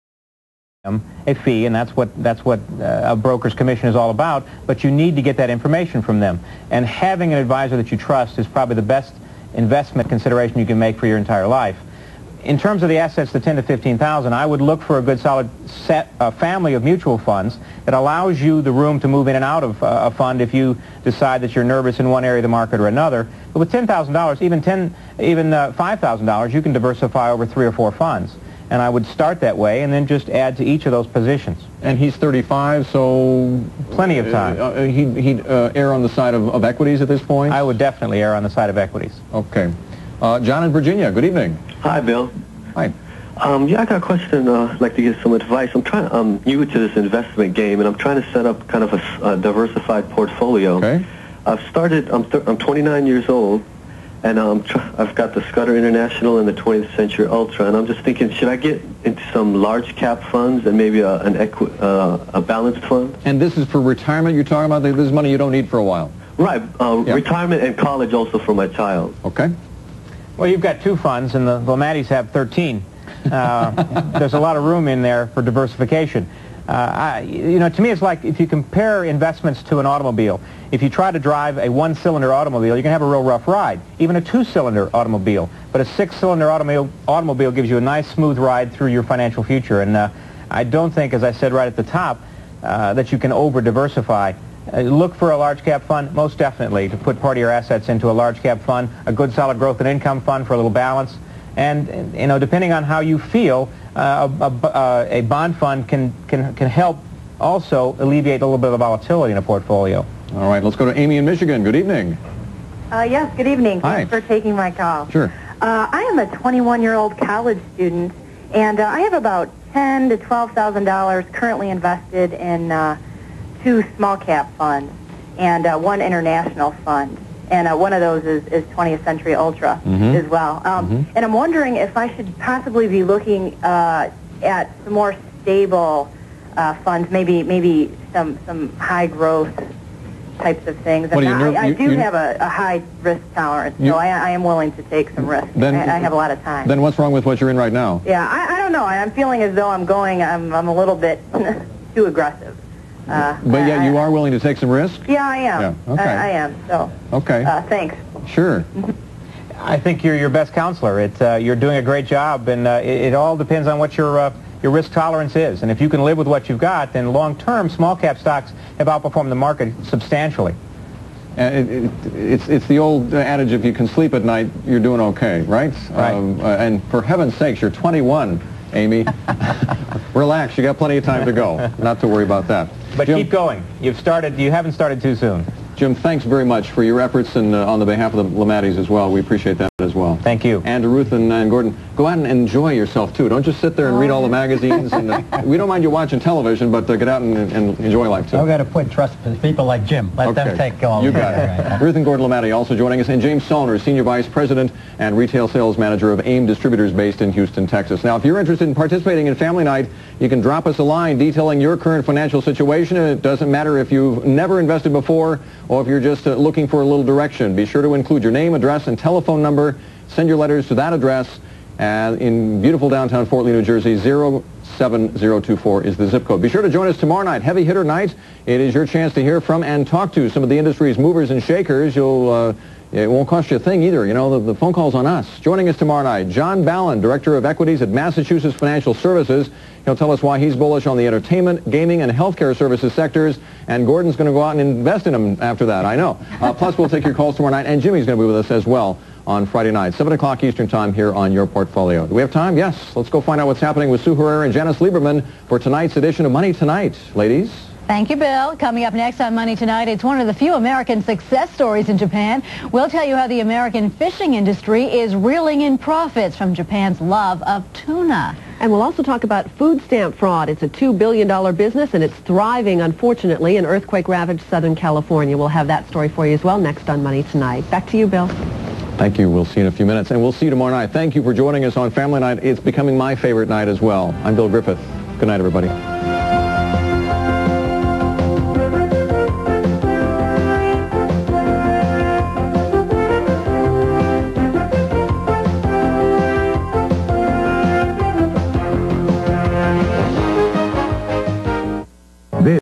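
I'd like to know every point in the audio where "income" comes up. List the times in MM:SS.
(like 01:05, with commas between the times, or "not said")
01:39.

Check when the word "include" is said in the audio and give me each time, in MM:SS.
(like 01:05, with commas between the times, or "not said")
03:37.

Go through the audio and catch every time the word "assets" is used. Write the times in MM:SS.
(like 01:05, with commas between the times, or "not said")
00:12, 01:37.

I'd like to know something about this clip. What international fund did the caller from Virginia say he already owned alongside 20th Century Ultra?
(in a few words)
Scudder International.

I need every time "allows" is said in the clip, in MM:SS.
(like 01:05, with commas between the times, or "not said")
00:17.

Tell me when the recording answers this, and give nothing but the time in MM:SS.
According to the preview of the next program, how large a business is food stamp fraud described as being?
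04:30.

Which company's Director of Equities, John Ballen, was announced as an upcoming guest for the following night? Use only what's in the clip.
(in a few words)
Massachusetts Financial Services.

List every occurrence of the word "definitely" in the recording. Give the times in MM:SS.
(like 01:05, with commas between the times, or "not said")
00:37, 01:36.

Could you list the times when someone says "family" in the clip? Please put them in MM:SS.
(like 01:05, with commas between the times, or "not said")
00:16, 03:29, 04:41.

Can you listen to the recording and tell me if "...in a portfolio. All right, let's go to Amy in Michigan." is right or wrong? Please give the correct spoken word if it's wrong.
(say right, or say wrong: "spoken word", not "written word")
right.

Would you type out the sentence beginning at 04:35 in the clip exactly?
We'll have that story for you as well next on Money Tonight.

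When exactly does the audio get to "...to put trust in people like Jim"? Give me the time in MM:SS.
03:18.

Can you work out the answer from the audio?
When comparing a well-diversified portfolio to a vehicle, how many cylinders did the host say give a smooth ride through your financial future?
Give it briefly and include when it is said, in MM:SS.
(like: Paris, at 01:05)
6, at 01:25.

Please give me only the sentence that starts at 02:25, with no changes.
Then, I, I, have a lot of time.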